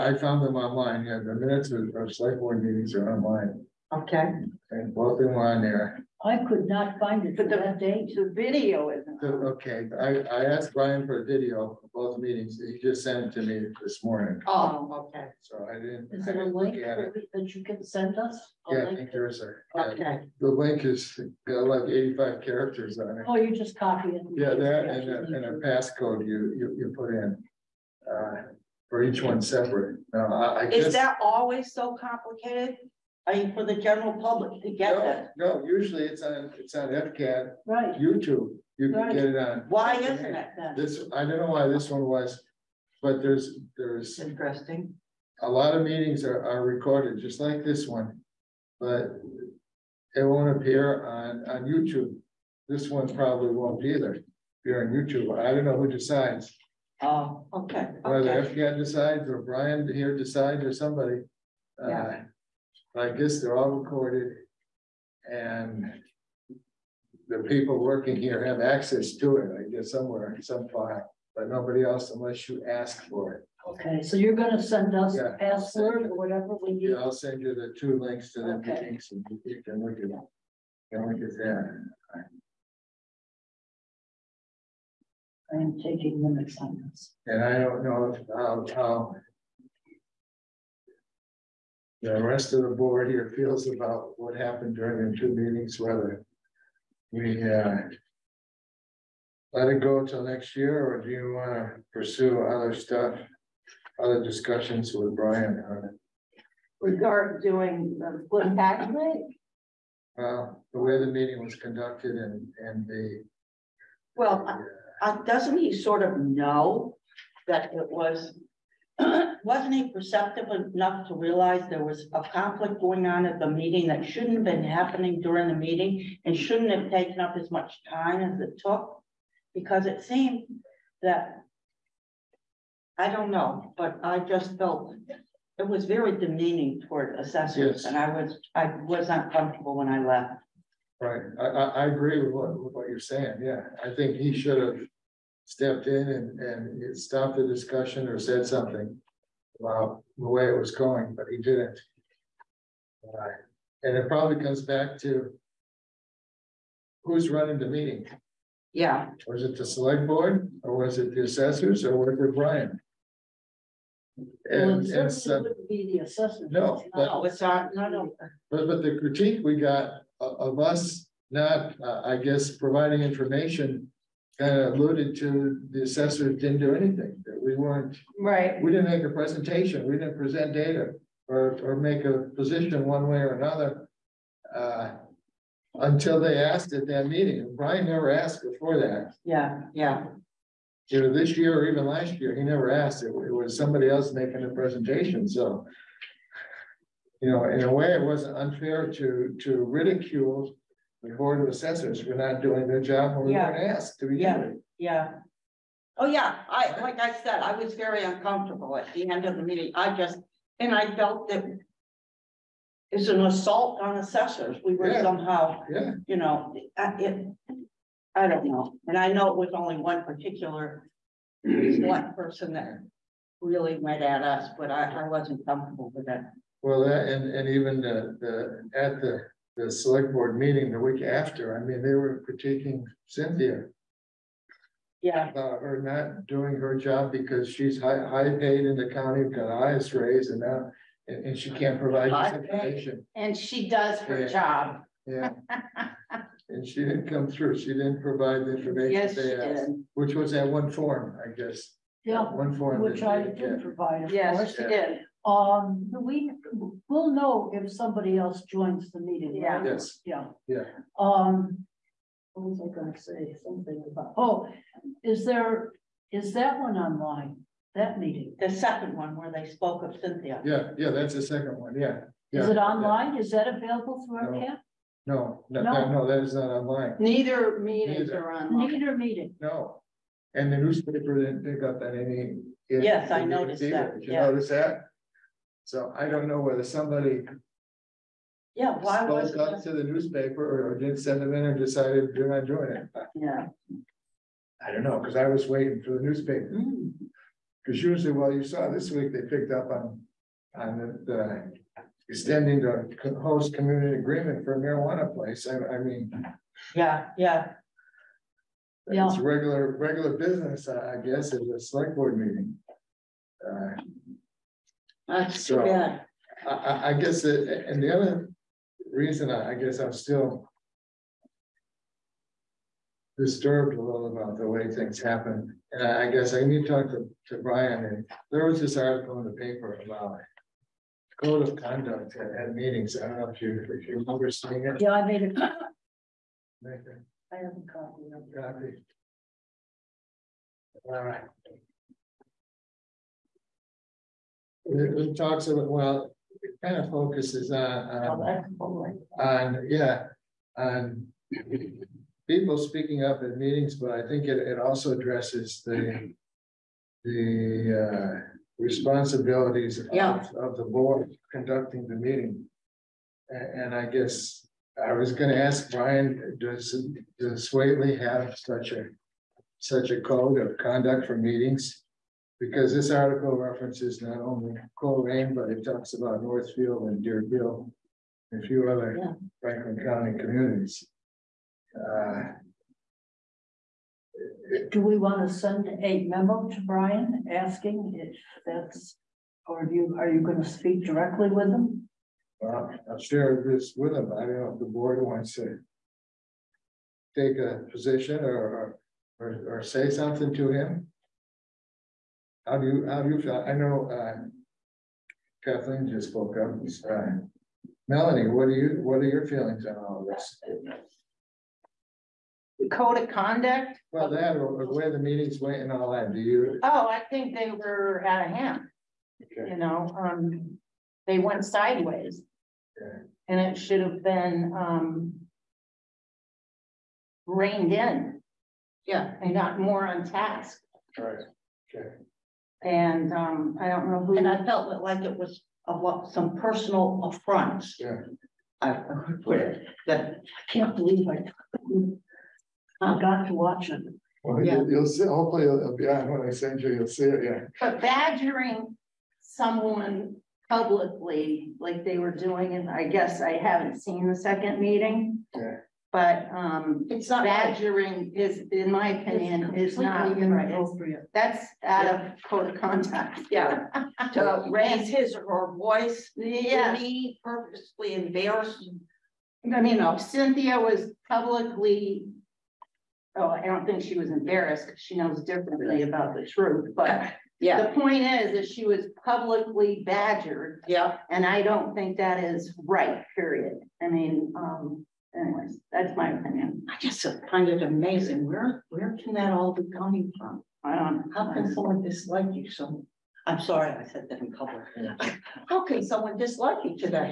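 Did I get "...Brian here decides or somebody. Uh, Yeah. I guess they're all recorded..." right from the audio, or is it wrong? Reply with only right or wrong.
right.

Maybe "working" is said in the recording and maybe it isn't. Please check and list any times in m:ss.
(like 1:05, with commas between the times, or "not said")
1:07.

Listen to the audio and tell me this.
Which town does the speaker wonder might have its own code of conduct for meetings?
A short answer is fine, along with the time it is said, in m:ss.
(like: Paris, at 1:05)
Whately, at 6:07.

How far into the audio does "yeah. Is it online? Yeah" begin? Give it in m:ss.
4:32.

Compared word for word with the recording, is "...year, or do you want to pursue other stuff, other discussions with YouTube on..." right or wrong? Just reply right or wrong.
wrong.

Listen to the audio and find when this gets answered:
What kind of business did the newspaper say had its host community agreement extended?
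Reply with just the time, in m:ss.
5:04.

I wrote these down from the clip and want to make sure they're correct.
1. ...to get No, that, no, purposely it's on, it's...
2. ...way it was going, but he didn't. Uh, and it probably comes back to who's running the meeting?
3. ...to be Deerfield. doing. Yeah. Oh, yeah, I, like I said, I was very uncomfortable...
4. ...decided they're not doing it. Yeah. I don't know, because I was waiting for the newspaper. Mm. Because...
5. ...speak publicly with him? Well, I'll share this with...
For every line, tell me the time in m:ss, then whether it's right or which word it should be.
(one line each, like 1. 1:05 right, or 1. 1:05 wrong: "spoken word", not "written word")
1. 0:34 wrong: "usually", not "purposely"
2. 2:30 right
3. 3:23 wrong: "Yeah", not "Deerfield"
4. 4:51 right
5. 6:30 wrong: "directly", not "publicly".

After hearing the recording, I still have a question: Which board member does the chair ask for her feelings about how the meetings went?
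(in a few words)
Melanie.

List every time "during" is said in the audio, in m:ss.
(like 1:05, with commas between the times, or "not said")
1:34, 2:05.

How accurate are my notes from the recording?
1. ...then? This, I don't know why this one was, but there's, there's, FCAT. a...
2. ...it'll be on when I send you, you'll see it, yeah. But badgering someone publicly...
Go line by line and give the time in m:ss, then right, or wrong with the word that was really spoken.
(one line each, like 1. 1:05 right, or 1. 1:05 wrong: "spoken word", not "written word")
1. 0:40 wrong: "Interesting", not "FCAT"
2. 7:25 right.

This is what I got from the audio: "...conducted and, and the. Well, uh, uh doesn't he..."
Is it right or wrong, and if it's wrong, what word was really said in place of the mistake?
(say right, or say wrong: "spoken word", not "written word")
right.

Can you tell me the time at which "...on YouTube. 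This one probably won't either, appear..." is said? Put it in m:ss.
0:51.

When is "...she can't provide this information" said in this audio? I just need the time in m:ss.
4:01.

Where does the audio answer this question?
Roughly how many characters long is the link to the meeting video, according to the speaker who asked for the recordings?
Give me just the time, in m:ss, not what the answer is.
0:21.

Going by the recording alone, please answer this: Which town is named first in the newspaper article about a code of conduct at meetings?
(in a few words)
Colrain.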